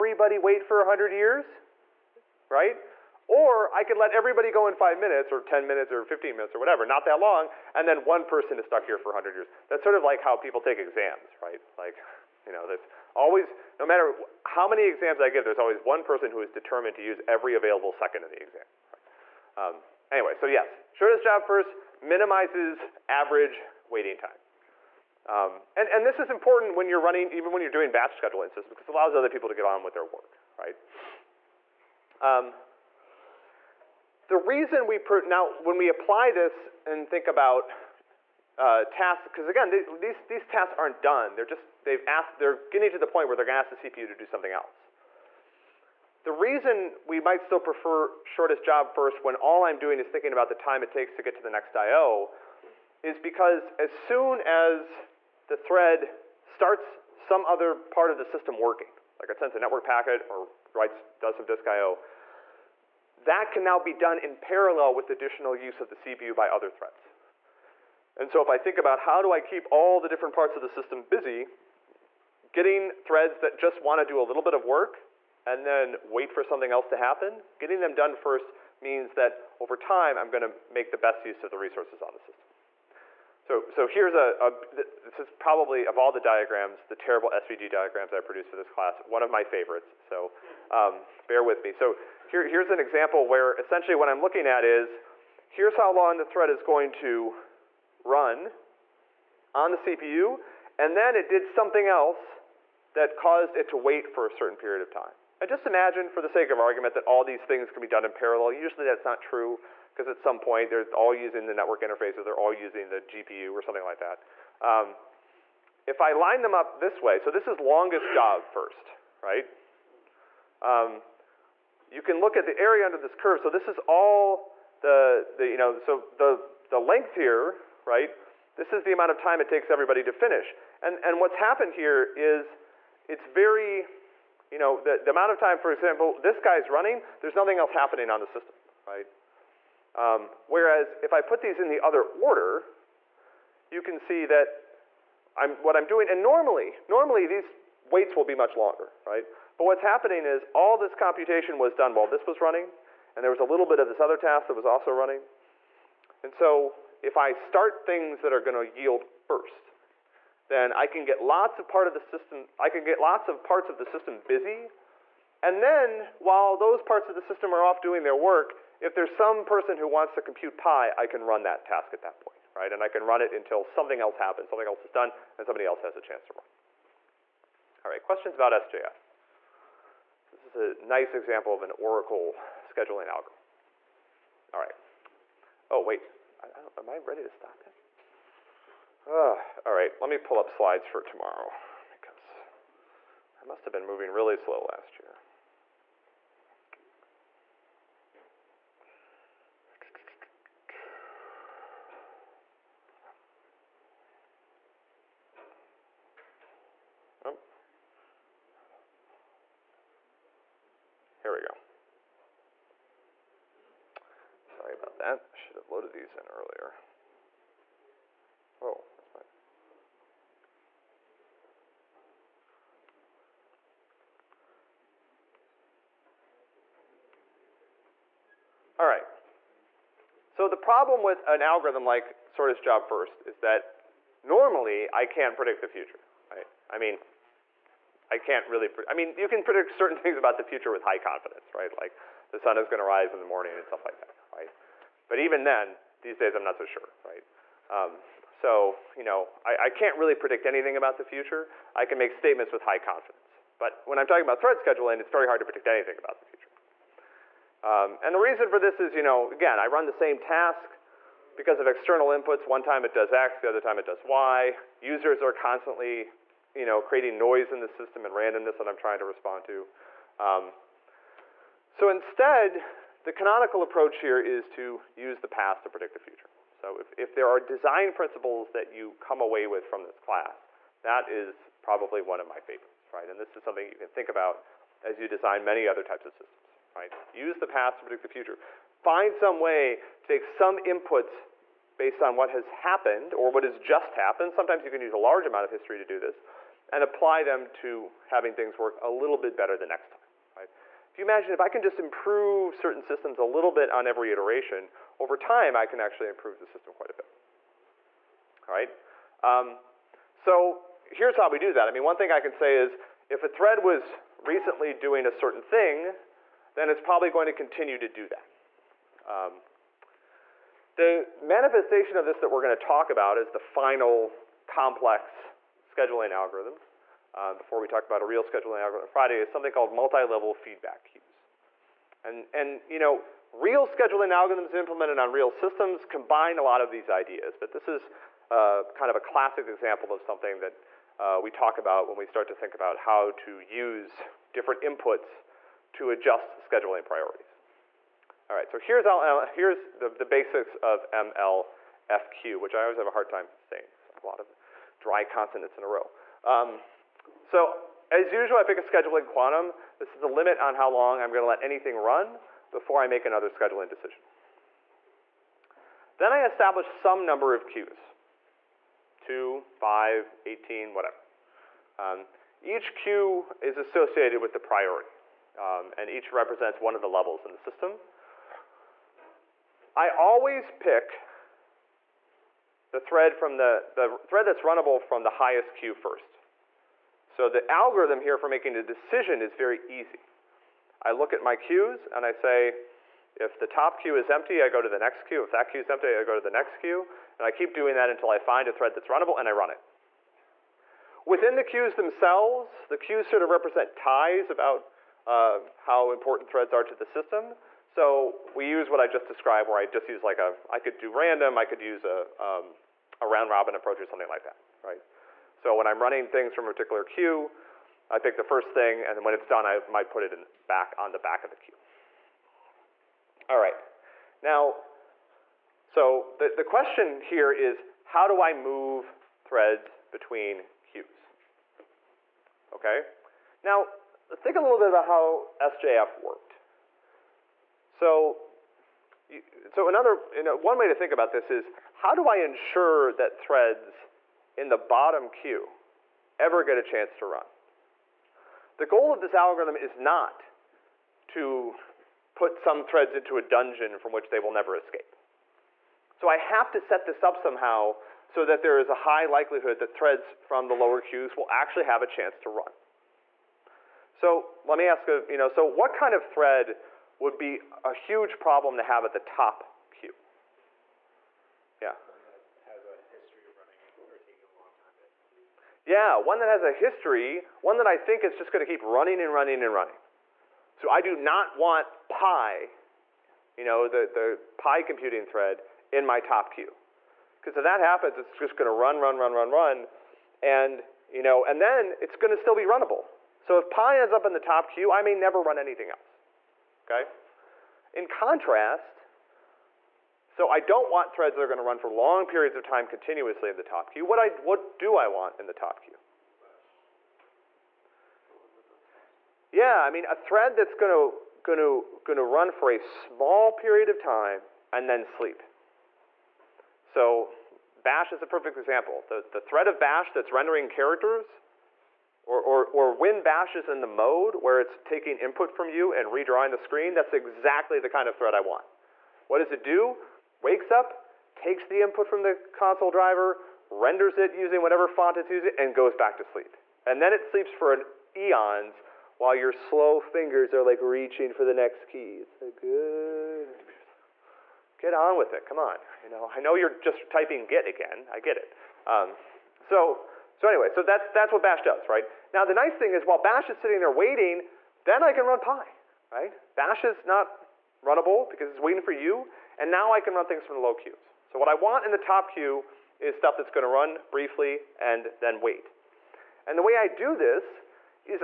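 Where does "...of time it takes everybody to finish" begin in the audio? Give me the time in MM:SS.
02:09.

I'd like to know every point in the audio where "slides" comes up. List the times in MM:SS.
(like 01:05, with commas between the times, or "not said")
03:10.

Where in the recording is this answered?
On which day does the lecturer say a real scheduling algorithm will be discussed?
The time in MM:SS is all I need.
05:28.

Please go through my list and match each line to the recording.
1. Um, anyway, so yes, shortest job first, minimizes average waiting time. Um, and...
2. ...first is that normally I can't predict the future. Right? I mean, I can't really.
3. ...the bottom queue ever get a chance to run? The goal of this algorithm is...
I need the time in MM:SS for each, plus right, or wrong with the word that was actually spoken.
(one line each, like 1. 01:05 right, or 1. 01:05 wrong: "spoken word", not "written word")
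1. 00:19 right
2. 03:52 right
3. 07:24 right.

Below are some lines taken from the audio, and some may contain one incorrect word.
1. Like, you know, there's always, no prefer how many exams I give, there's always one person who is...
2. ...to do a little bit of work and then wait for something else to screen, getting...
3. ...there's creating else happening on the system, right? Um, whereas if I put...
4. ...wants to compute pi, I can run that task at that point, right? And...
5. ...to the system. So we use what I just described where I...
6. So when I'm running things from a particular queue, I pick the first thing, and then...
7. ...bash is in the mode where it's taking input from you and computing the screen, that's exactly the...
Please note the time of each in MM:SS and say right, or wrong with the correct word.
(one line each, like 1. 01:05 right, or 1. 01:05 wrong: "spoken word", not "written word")
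1. 00:11 wrong: "matter", not "prefer"
2. 01:13 wrong: "happen", not "screen"
3. 02:17 wrong: "nothing", not "creating"
4. 02:49 right
5. 06:46 right
6. 06:55 right
7. 08:43 wrong: "redrawing", not "computing".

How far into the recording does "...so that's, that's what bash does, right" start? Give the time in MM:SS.
09:10.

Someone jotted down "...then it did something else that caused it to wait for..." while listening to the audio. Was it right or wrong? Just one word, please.
right.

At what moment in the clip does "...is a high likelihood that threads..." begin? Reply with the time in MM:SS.
07:38.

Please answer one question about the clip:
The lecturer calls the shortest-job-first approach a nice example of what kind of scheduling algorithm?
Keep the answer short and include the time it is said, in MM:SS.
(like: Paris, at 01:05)
Oracle, at 03:01.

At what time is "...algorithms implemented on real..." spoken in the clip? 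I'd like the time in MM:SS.
05:34.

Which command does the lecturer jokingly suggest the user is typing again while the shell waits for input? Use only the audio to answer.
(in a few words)
Git.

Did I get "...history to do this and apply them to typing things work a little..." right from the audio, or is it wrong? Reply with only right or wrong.
wrong.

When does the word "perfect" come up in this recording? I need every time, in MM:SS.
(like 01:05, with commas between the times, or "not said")
08:38.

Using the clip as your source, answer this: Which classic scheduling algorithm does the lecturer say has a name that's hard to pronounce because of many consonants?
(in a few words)
multi-level feedback queues.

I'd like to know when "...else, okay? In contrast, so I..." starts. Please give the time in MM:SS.
08:15.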